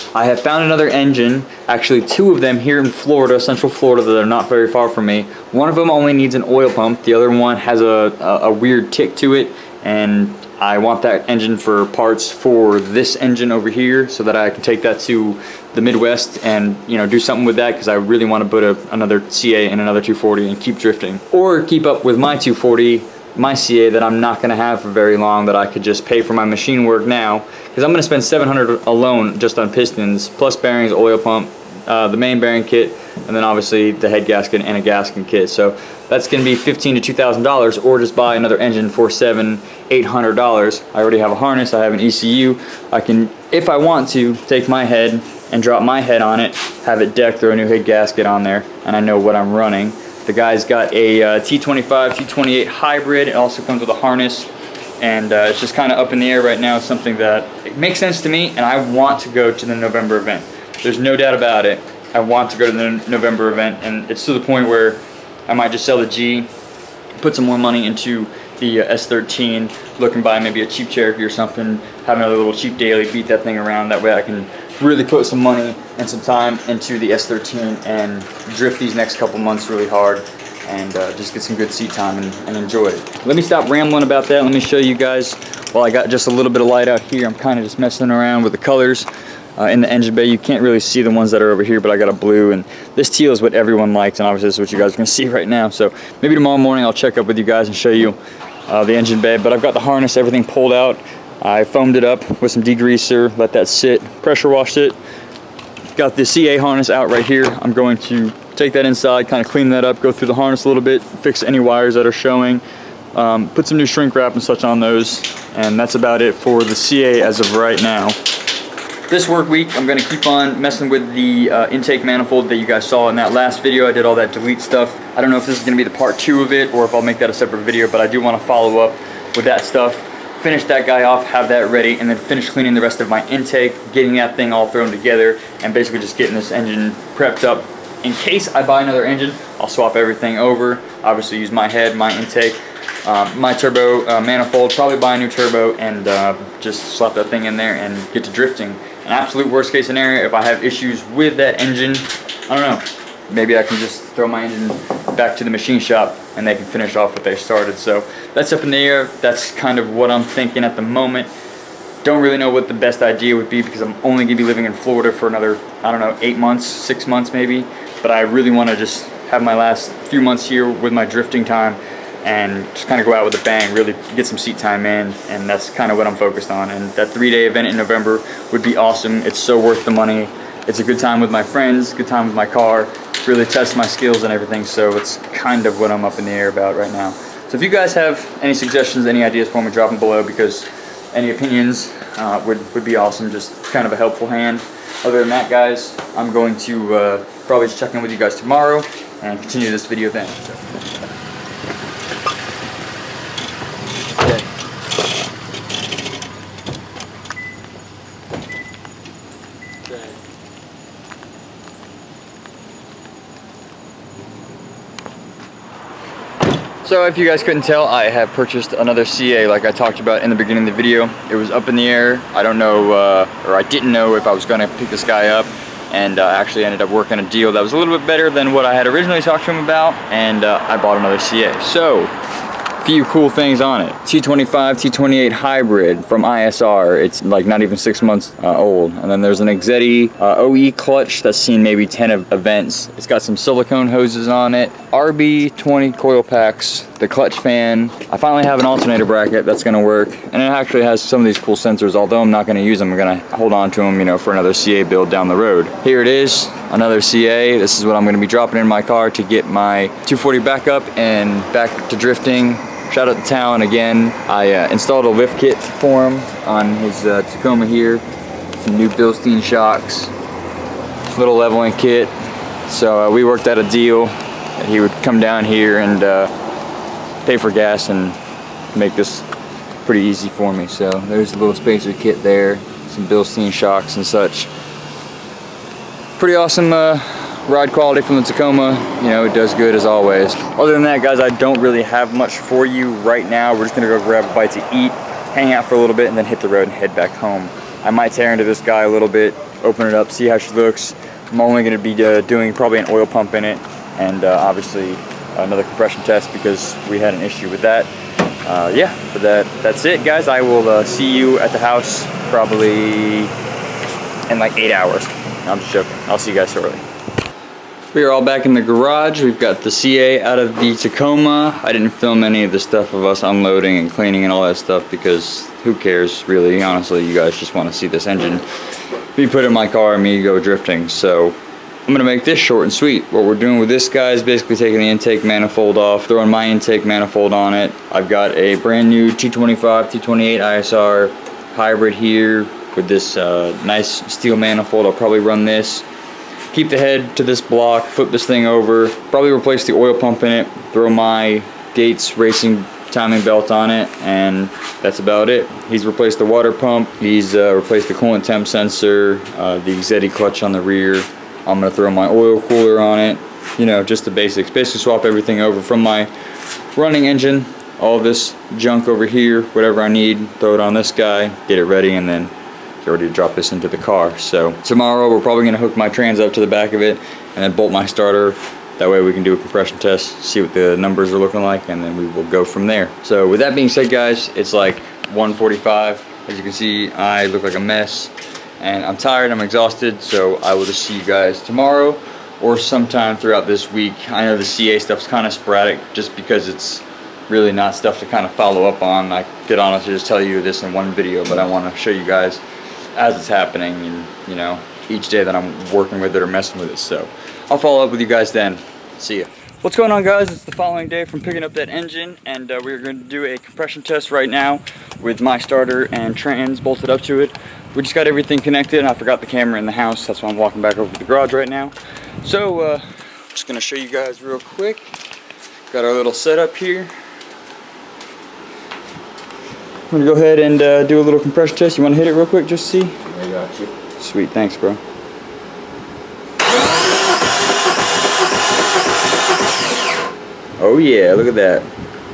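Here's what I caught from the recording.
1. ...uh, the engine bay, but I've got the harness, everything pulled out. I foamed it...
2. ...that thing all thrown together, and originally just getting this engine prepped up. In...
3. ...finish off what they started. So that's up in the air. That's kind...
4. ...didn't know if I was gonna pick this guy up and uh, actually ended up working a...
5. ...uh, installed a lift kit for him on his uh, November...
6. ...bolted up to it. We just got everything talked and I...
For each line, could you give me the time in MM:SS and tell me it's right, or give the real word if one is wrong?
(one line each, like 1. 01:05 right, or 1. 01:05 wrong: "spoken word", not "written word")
1. 01:38 right
2. 02:14 wrong: "basically", not "originally"
3. 02:36 right
4. 03:43 right
5. 04:24 wrong: "Tacoma", not "November"
6. 06:56 wrong: "connected", not "talked".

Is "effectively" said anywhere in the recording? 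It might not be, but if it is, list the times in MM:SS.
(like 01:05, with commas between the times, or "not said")
not said.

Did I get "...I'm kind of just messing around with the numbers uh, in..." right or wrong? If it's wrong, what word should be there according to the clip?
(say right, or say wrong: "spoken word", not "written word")
wrong: "colors", not "numbers".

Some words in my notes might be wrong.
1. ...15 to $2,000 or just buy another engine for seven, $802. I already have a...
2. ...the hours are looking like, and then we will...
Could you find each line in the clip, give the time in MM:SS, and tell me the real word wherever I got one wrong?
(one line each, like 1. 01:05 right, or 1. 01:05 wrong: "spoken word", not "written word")
1. 00:36 wrong: "800", not "802"
2. 06:20 wrong: "numbers", not "hours".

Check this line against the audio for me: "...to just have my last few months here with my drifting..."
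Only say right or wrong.
right.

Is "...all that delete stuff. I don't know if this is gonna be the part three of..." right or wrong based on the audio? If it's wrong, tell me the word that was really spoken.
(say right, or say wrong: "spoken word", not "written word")
wrong: "two", not "three".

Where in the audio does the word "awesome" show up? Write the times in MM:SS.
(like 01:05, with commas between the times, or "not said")
02:58, 03:12, 04:46.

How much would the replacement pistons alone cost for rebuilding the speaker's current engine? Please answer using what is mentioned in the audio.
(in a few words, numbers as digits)
700.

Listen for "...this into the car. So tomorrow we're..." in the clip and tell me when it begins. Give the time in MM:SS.
06:13.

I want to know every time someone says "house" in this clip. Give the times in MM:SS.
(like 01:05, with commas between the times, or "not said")
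05:11, 06:59.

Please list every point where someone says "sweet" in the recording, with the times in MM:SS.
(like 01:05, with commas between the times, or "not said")
05:32, 07:14.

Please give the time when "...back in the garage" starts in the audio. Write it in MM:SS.
05:18.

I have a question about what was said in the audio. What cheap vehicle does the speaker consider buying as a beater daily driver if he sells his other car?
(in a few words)
Cherokee.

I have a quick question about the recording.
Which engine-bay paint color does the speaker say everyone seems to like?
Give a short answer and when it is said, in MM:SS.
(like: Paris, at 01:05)
teal, at 01:32.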